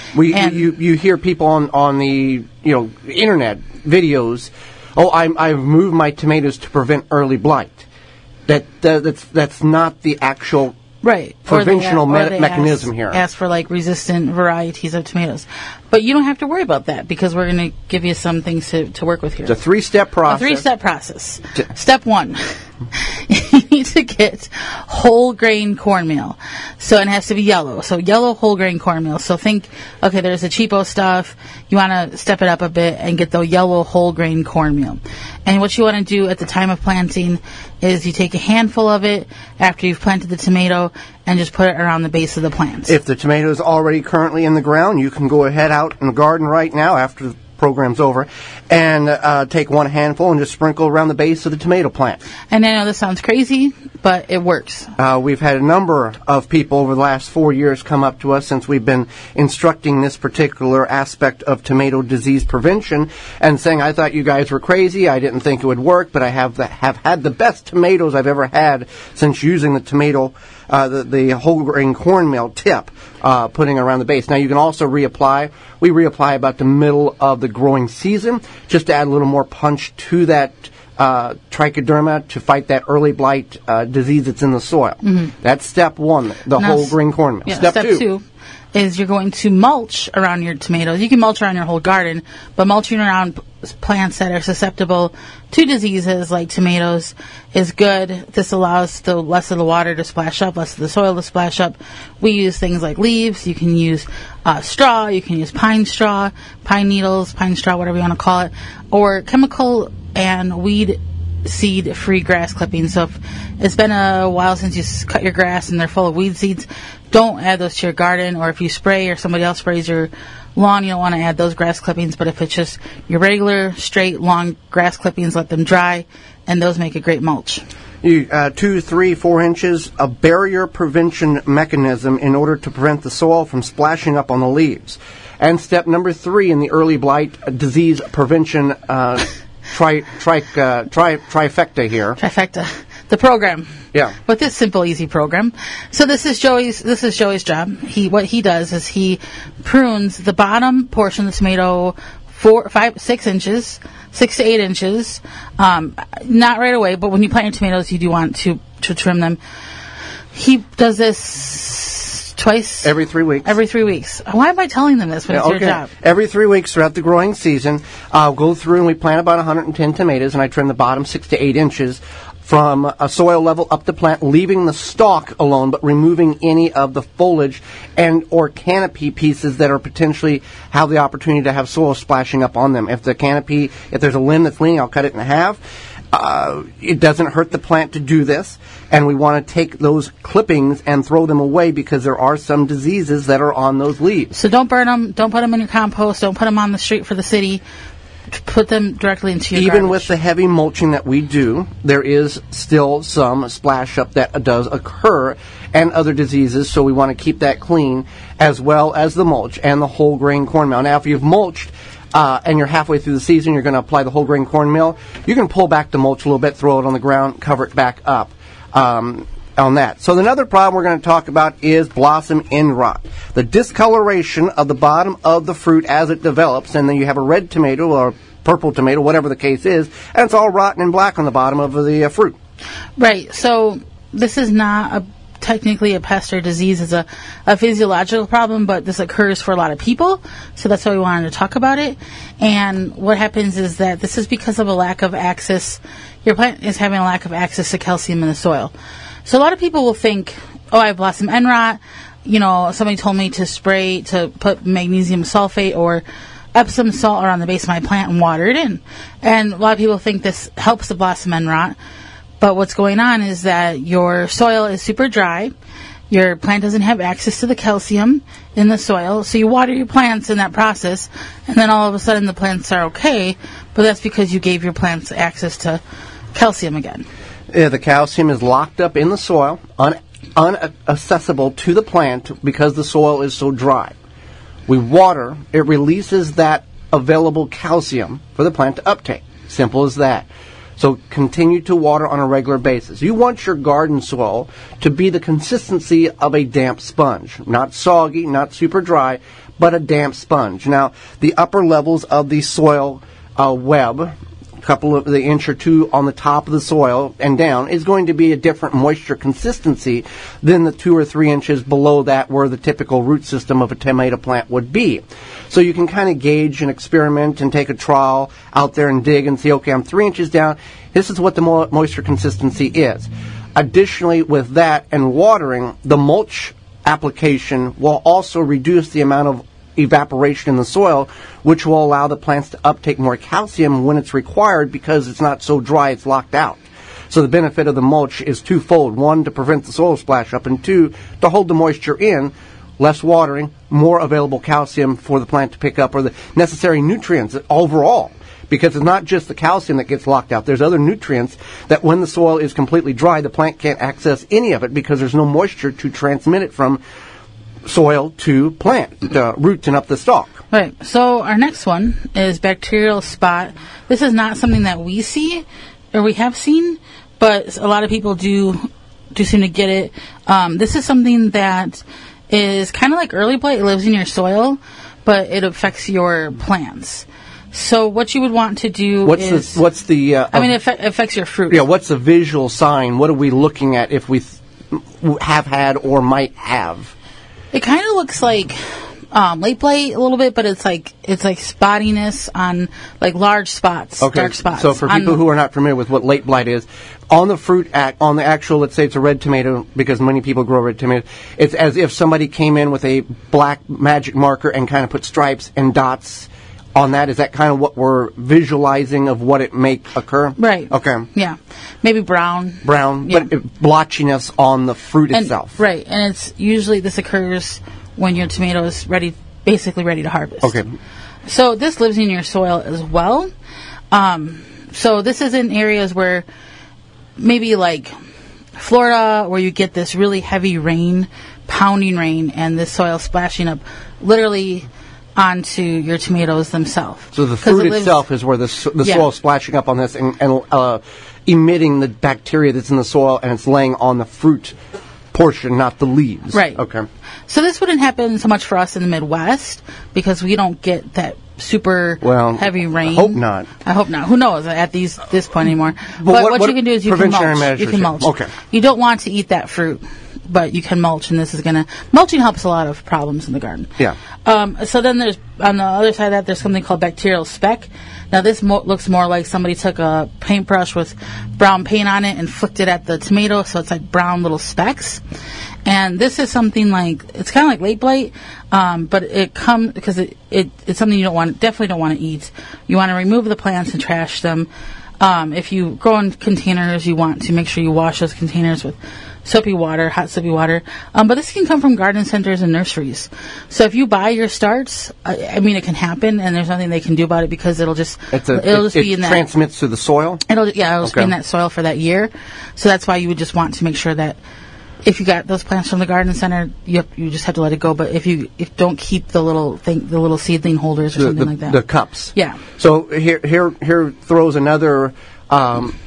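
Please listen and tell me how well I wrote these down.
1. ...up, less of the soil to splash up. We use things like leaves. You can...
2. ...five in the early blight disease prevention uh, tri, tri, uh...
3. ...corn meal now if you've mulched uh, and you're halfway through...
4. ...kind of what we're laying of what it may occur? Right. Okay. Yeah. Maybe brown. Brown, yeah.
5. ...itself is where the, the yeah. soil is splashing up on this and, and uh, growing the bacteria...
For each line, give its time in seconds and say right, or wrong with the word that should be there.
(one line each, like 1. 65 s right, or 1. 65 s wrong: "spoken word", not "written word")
1. 100 s right
2. 136 s wrong: "three", not "five"
3. 210 s right
4. 407 s wrong: "visualizing", not "laying"
5. 437 s wrong: "emitting", not "growing".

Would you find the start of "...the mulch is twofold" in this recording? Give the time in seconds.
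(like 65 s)
337 s.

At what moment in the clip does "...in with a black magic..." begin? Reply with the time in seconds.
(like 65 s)
402 s.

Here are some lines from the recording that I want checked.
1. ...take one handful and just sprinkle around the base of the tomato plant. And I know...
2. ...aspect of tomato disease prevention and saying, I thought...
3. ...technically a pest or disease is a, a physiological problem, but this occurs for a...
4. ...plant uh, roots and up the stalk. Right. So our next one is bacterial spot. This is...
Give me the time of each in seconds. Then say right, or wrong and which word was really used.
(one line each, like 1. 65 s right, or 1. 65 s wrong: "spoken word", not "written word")
1. 49 s right
2. 60 s right
3. 235 s right
4. 358 s right.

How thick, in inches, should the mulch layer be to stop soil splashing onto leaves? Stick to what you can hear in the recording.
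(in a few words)
2 to 4 inches.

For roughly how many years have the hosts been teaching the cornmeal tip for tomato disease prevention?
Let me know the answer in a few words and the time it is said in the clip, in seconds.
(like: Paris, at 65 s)
4, at 57 s.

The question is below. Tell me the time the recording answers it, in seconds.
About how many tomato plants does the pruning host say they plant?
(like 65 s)
169 s.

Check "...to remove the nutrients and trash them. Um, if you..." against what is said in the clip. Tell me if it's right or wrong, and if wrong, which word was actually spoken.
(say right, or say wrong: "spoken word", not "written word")
wrong: "plants", not "nutrients".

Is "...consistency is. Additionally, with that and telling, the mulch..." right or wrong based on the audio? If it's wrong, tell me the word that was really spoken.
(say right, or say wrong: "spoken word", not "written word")
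wrong: "watering", not "telling".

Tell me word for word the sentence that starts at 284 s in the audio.
We water, it releases that available calcium for the plant to uptake.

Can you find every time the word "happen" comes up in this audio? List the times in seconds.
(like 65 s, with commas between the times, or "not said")
243 s, 447 s, 495 s.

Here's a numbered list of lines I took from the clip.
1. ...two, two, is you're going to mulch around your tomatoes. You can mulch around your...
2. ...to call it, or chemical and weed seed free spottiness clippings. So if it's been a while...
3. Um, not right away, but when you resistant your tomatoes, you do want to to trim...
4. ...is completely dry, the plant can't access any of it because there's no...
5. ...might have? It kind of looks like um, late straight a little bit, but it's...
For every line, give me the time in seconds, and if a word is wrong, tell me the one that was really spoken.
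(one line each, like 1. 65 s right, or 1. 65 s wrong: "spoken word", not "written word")
1. 87 s right
2. 108 s wrong: "grass", not "spottiness"
3. 155 s wrong: "plant", not "resistant"
4. 352 s right
5. 386 s wrong: "blight", not "straight".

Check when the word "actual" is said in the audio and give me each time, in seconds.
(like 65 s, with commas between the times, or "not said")
10 s, 398 s.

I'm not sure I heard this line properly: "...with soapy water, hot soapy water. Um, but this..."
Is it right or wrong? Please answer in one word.
right.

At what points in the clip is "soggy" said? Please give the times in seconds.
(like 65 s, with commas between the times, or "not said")
297 s.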